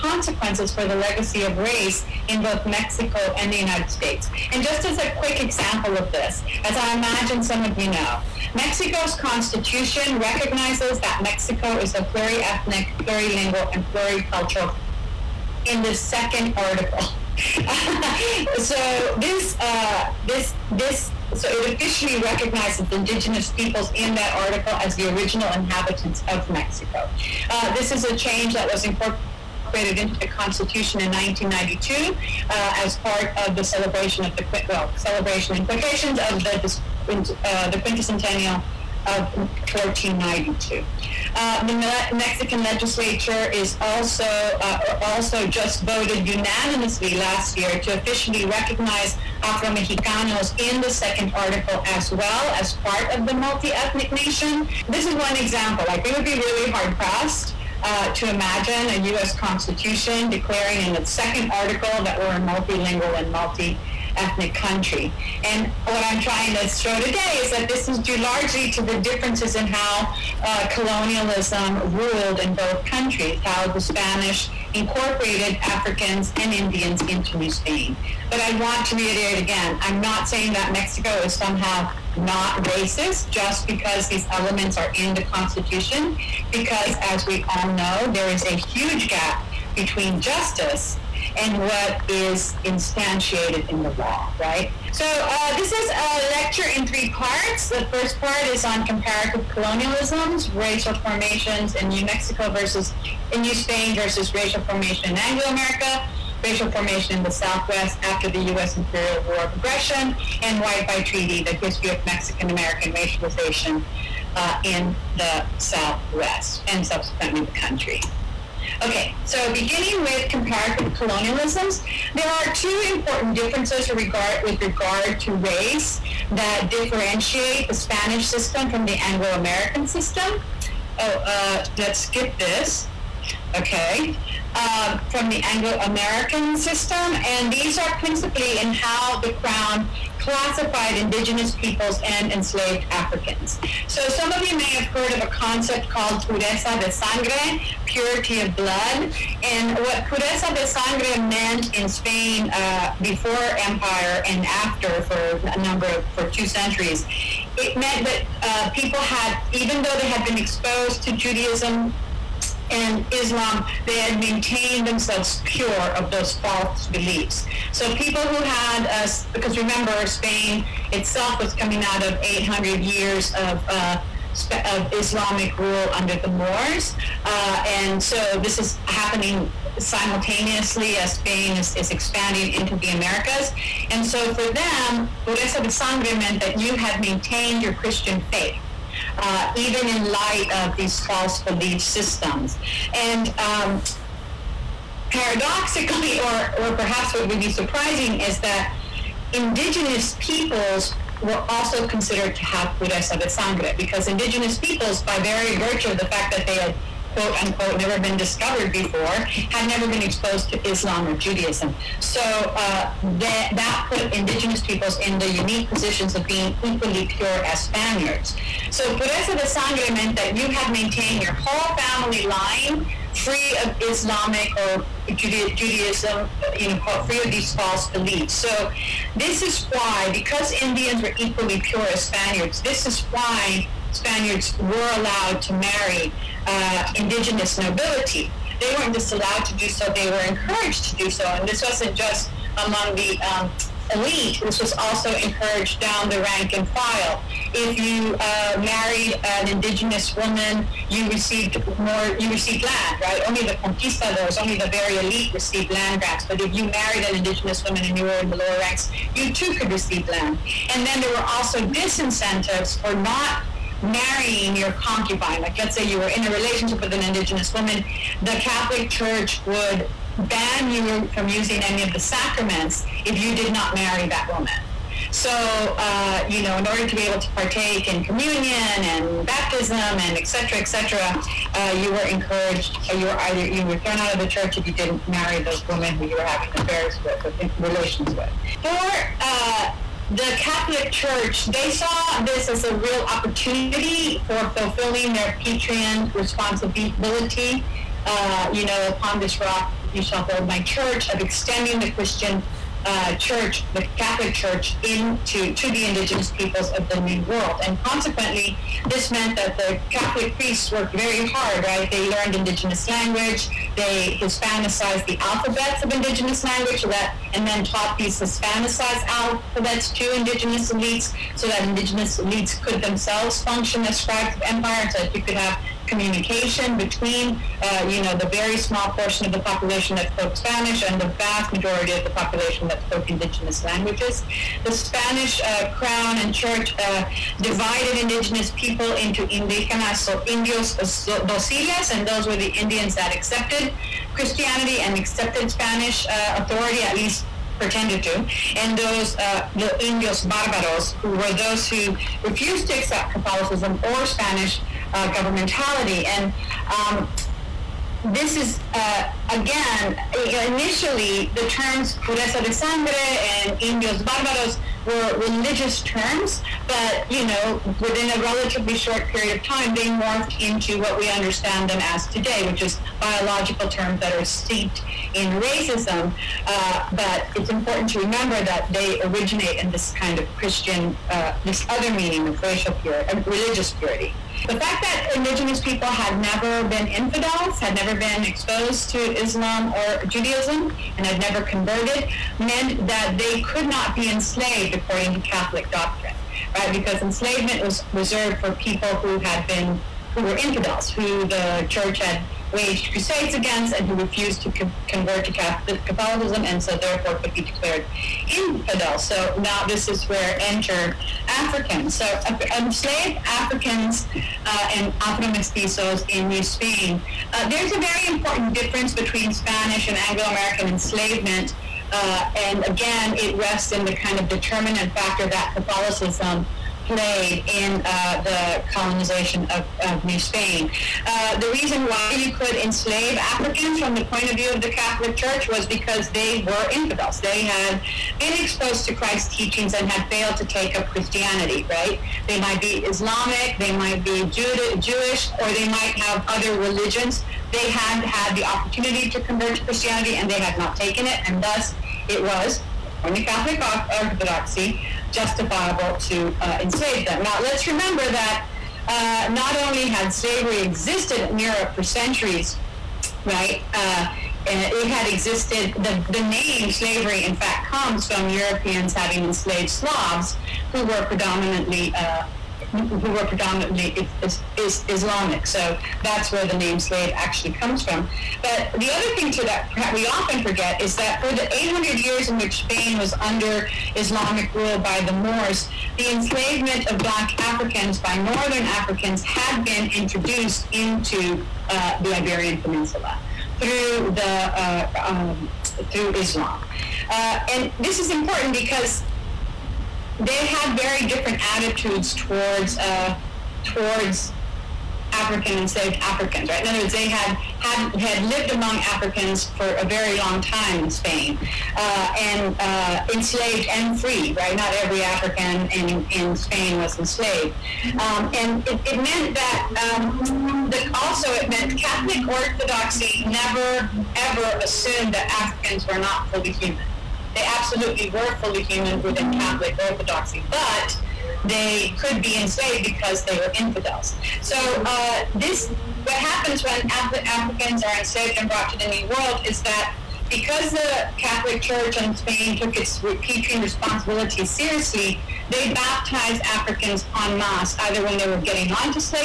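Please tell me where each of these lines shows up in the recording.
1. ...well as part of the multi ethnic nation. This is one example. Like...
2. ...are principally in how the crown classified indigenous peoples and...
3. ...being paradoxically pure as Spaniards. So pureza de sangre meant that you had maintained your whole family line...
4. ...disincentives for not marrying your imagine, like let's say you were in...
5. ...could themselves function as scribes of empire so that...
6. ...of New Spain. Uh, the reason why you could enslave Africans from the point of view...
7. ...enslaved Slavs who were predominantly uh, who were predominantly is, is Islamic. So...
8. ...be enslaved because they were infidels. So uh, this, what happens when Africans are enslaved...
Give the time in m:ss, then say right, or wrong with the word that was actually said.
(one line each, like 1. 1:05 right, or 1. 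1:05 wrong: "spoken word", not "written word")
1. 0:52 right
2. 2:17 right
3. 3:36 wrong: "equally", not "paradoxically"
4. 4:21 wrong: "concubine", not "imagine"
5. 5:22 right
6. 7:09 right
7. 7:49 right
8. 8:52 right.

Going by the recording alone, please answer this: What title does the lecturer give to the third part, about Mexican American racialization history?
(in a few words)
White by Treaty.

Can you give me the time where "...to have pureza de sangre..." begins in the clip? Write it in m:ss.
3:22.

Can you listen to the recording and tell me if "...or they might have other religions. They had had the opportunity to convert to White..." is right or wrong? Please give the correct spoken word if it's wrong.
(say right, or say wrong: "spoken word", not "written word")
wrong: "Christianity", not "White".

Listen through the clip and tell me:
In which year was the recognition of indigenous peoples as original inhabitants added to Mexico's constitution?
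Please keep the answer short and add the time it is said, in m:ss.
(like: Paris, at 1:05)
1992, at 0:31.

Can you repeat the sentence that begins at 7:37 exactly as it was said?
Now, let's remember that uh, not only had slavery existed in Europe for centuries, right?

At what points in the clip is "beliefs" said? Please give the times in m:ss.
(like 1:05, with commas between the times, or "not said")
2:46, 3:11, 3:47.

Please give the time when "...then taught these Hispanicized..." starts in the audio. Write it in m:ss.
5:17.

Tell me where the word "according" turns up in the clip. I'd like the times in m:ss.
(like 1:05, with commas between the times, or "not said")
6:34, 7:32.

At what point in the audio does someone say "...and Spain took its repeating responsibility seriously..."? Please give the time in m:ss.
9:01.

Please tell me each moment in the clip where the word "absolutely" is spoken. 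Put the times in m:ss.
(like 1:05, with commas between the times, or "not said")
8:47.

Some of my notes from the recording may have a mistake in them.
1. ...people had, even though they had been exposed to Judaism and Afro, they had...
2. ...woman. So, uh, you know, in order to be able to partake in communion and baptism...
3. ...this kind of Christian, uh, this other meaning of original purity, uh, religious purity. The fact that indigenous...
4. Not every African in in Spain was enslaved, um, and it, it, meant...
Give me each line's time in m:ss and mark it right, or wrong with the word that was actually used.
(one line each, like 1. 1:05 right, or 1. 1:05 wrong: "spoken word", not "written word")
1. 2:38 wrong: "Islam", not "Afro"
2. 4:34 right
3. 6:19 wrong: "racial", not "original"
4. 8:34 right.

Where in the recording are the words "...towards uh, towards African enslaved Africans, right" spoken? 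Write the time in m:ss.
8:22.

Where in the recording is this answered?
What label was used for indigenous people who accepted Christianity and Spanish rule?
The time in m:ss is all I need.
5:40.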